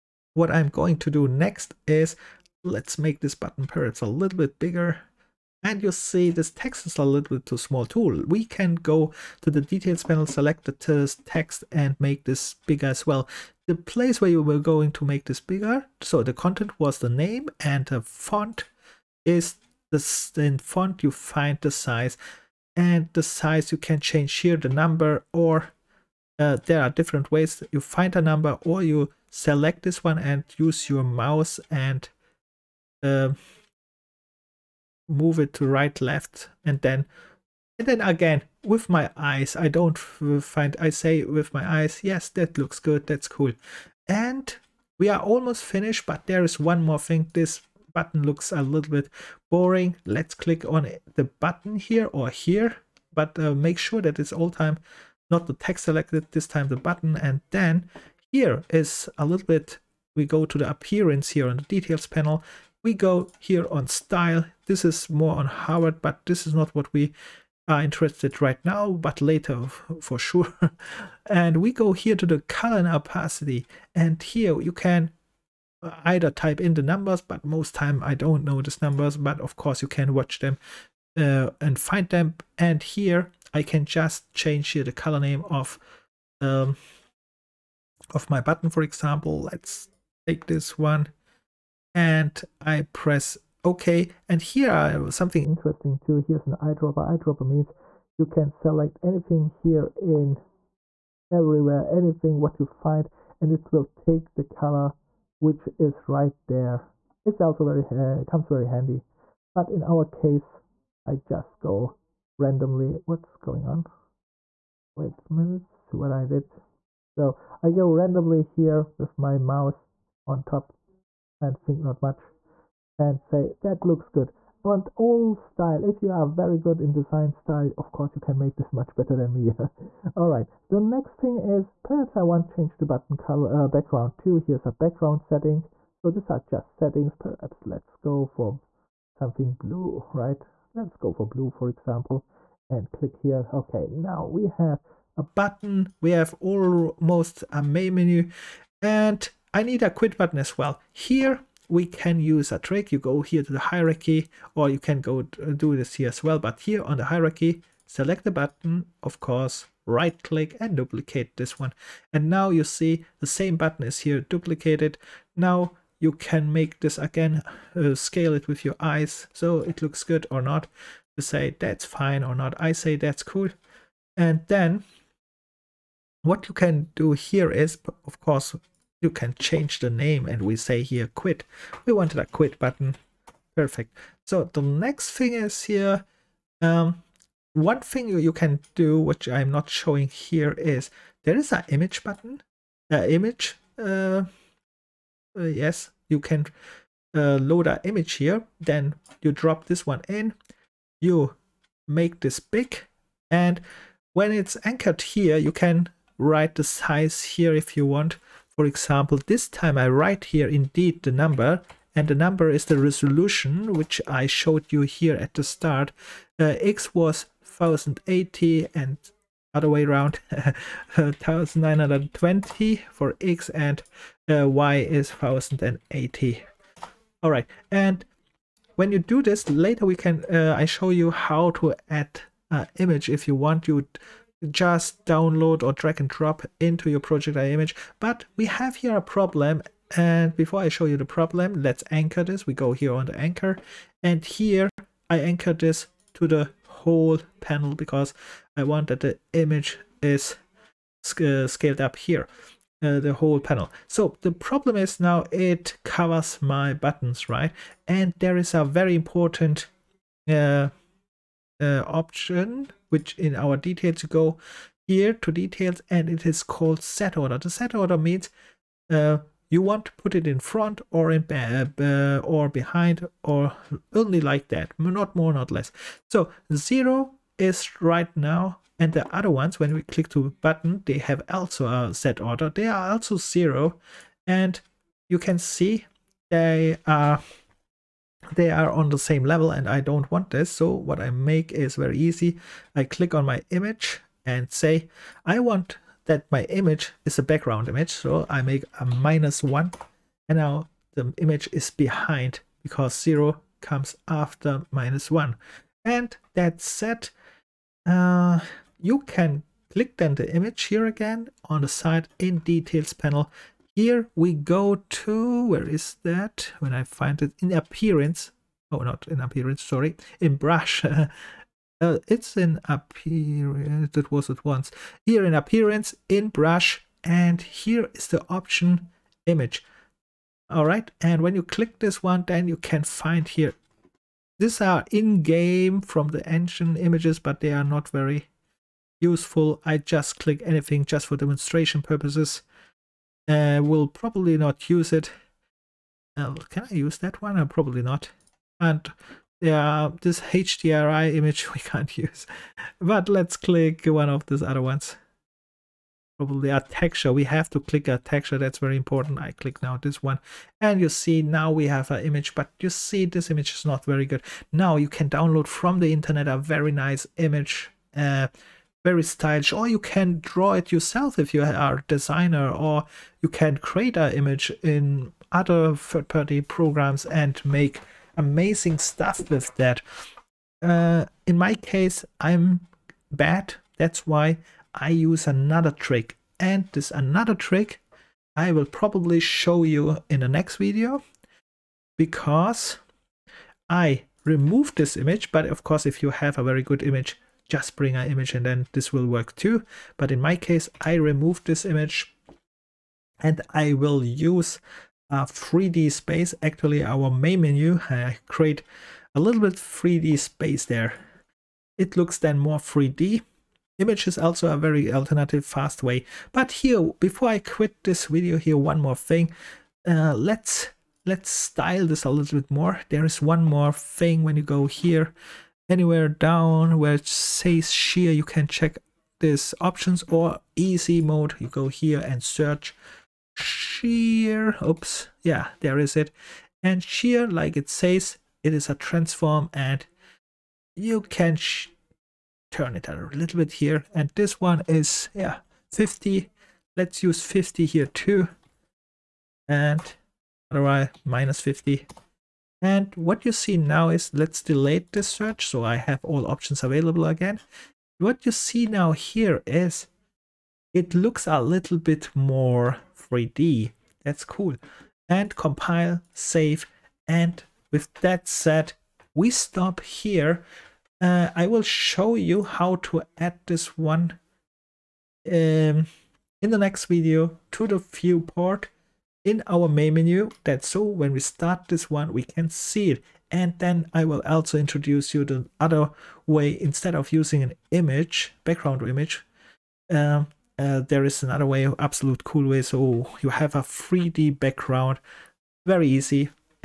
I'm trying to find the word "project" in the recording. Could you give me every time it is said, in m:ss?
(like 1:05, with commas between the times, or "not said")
3:56.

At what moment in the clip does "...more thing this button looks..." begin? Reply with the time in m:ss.
0:46.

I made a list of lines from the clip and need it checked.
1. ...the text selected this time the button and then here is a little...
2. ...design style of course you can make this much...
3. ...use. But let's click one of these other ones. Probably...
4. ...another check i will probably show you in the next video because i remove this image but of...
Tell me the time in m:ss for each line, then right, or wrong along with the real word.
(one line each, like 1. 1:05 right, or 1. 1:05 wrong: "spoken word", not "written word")
1. 0:55 right
2. 2:06 right
3. 5:51 right
4. 6:26 wrong: "trick", not "check".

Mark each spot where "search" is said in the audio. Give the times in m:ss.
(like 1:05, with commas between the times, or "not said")
7:12, 7:35.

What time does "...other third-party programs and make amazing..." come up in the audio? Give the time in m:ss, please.
6:15.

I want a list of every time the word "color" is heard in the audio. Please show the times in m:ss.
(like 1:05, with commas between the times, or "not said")
1:12, 1:24, 1:44, 2:13.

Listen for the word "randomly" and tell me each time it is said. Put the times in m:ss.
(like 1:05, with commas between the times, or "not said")
1:52, 1:57.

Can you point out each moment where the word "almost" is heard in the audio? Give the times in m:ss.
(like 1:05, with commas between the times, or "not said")
0:45, 2:26.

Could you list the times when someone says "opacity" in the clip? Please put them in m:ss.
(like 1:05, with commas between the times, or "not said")
1:12.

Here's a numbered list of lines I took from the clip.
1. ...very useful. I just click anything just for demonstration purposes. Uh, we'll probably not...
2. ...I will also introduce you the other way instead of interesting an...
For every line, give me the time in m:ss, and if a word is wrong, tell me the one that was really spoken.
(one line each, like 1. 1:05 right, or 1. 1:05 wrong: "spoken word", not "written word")
1. 5:37 right
2. 8:03 wrong: "using", not "interesting".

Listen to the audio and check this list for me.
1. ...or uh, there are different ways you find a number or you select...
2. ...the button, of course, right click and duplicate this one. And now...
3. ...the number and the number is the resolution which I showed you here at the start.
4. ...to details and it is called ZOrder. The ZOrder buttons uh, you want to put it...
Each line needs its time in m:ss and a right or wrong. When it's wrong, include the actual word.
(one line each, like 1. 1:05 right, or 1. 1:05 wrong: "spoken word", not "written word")
1. 0:25 right
2. 2:38 right
3. 3:31 right
4. 4:25 wrong: "means", not "buttons".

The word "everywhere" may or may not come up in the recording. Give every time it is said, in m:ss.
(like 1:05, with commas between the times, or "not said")
1:41.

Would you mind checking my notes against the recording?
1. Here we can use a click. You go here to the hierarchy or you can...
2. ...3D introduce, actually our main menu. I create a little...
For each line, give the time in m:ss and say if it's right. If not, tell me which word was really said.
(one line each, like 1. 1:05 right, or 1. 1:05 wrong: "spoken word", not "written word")
1. 2:30 wrong: "trick", not "click"
2. 6:45 wrong: "space", not "introduce".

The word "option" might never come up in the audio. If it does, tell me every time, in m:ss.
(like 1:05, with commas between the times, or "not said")
4:21, 5:28, 7:09, 7:36.